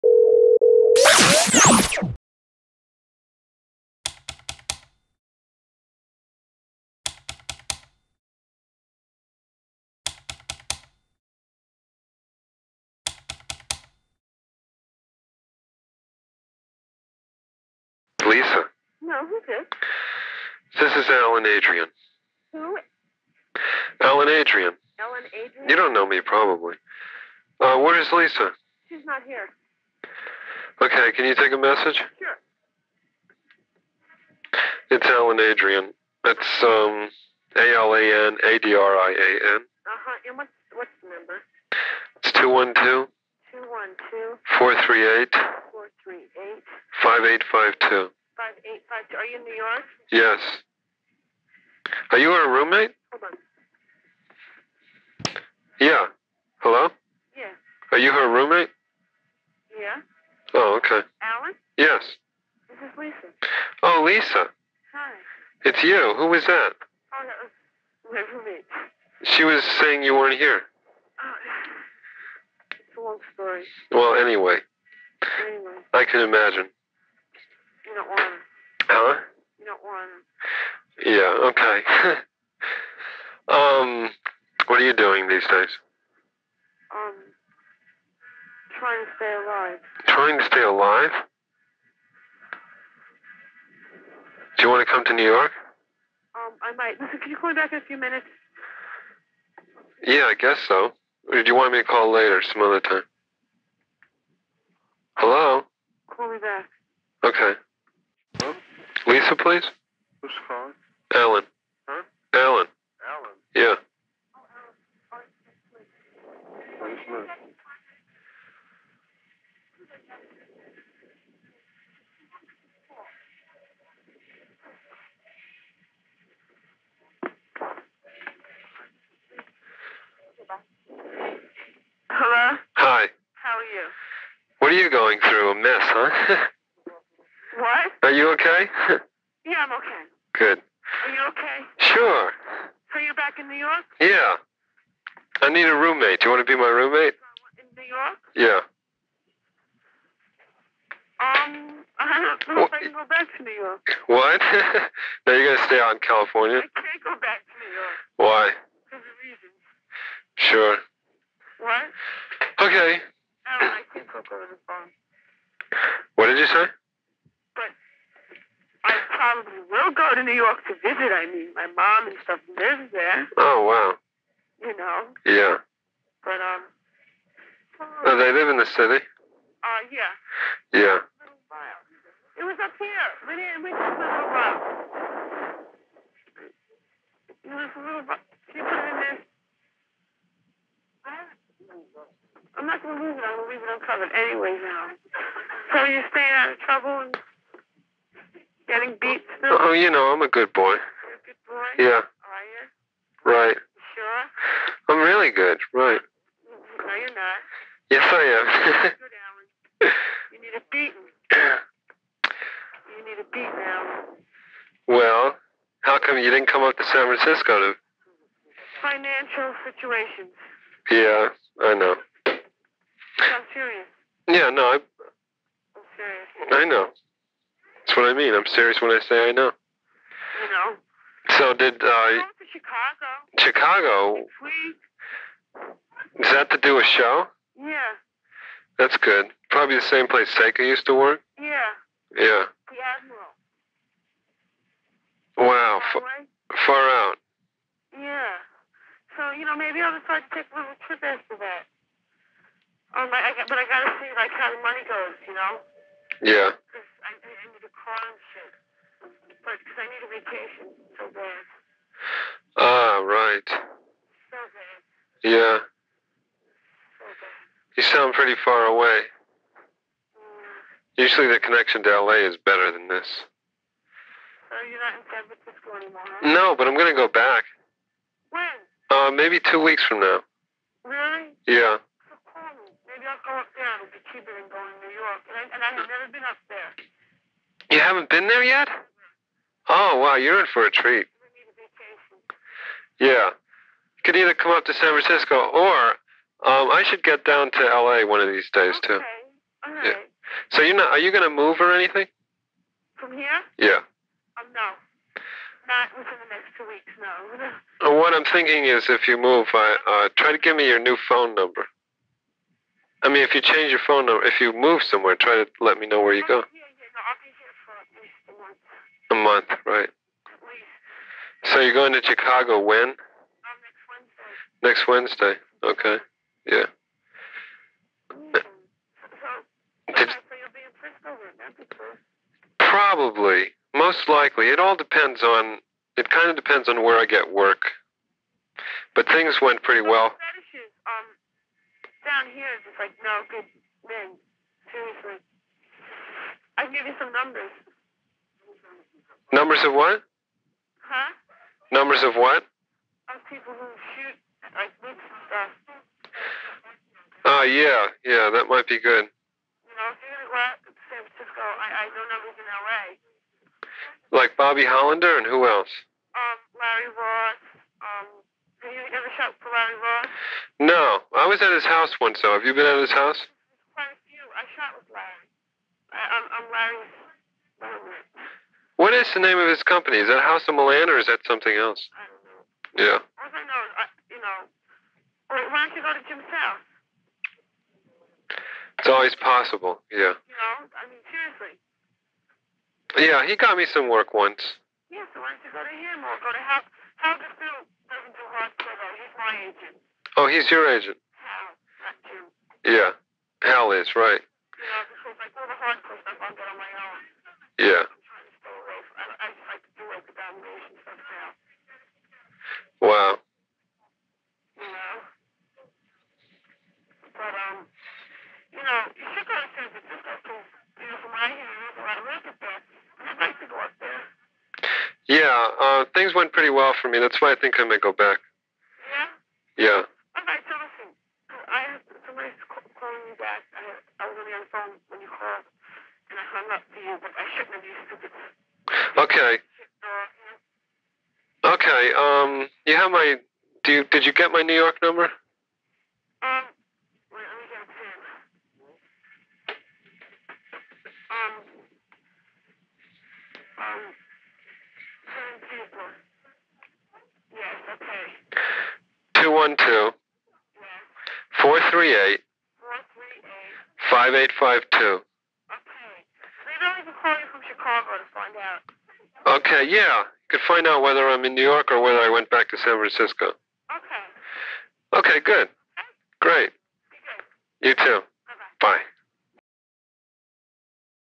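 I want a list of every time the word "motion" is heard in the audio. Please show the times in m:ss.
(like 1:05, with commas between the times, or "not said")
not said.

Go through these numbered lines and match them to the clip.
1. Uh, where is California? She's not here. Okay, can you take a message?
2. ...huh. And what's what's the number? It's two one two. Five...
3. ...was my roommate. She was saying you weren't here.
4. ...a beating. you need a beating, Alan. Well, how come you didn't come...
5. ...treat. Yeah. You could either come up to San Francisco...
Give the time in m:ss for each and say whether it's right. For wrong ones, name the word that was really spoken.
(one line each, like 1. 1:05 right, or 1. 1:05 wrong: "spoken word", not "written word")
1. 0:27 wrong: "Lisa", not "California"
2. 0:39 wrong: "Two", not "Five"
3. 1:07 right
4. 3:30 right
5. 4:50 right.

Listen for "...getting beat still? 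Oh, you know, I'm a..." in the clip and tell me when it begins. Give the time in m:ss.
3:18.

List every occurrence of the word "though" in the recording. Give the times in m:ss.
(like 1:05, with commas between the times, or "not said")
6:12, 6:38.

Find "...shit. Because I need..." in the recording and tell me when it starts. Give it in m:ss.
4:18.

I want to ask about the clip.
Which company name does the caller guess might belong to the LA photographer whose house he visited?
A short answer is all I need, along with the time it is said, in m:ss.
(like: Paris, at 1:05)
House of Milan, at 6:20.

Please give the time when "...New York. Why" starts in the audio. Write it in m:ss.
2:37.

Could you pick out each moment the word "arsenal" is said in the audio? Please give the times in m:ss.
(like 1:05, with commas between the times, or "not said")
not said.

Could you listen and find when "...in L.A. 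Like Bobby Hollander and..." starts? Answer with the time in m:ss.
6:02.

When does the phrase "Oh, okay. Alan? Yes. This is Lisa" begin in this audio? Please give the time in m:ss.
1:00.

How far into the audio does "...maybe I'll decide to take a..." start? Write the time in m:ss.
4:09.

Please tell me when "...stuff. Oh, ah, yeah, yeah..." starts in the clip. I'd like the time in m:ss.
5:55.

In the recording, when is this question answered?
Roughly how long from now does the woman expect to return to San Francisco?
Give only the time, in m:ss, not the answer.
4:39.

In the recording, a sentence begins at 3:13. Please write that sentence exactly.
I'm gonna leave it uncovered anyway now.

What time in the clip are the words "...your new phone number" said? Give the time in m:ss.
5:10.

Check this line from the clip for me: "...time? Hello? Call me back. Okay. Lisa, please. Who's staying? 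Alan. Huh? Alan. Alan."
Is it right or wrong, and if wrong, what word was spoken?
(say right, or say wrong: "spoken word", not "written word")
wrong: "calling", not "staying".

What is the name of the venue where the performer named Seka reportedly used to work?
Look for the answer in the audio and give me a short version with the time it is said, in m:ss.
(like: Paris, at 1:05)
The Admiral, at 4:02.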